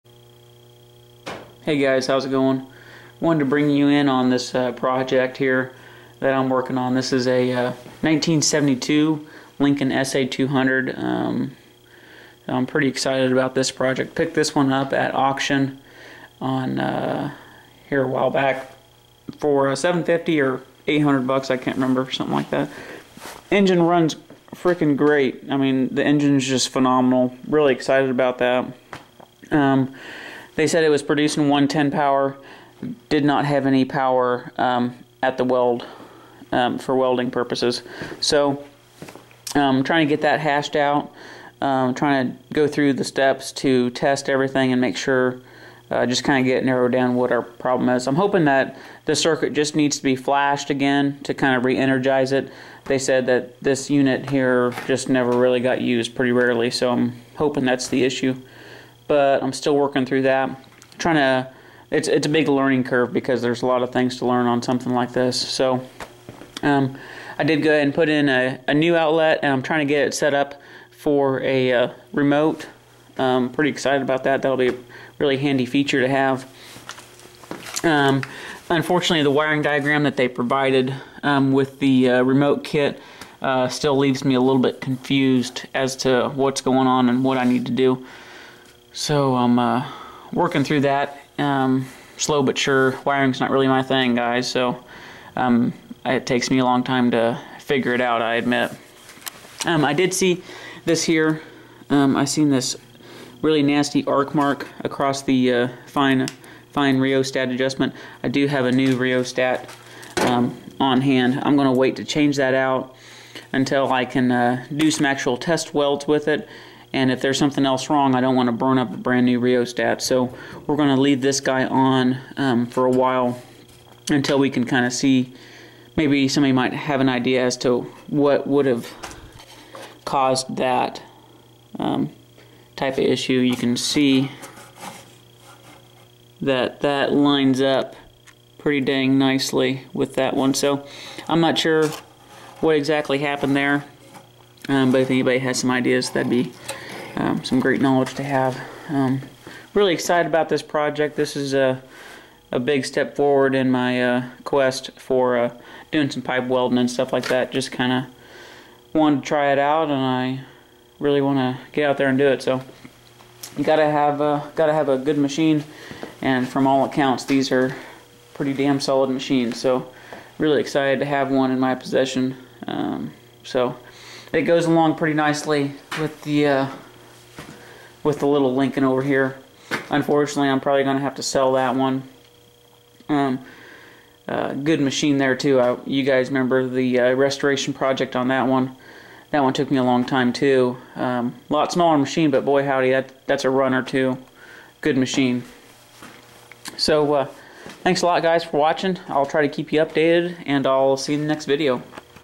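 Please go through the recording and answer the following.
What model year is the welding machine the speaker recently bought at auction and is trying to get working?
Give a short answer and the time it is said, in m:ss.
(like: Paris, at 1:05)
1972, at 0:08.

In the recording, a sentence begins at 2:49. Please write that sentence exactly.
So really excited to have one in my possession.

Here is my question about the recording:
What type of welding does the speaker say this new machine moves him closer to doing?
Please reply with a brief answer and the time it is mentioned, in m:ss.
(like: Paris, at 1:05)
pipe welding, at 2:36.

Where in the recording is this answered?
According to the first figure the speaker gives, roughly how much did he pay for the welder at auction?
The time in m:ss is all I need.
0:19.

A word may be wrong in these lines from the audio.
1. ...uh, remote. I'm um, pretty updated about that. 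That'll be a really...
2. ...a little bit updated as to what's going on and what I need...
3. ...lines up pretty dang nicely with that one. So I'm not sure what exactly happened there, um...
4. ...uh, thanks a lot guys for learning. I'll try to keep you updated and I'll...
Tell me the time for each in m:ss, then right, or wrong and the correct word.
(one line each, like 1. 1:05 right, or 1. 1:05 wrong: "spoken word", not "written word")
1. 1:11 wrong: "excited", not "updated"
2. 1:24 wrong: "confused", not "updated"
3. 2:17 right
4. 3:17 wrong: "watching", not "learning".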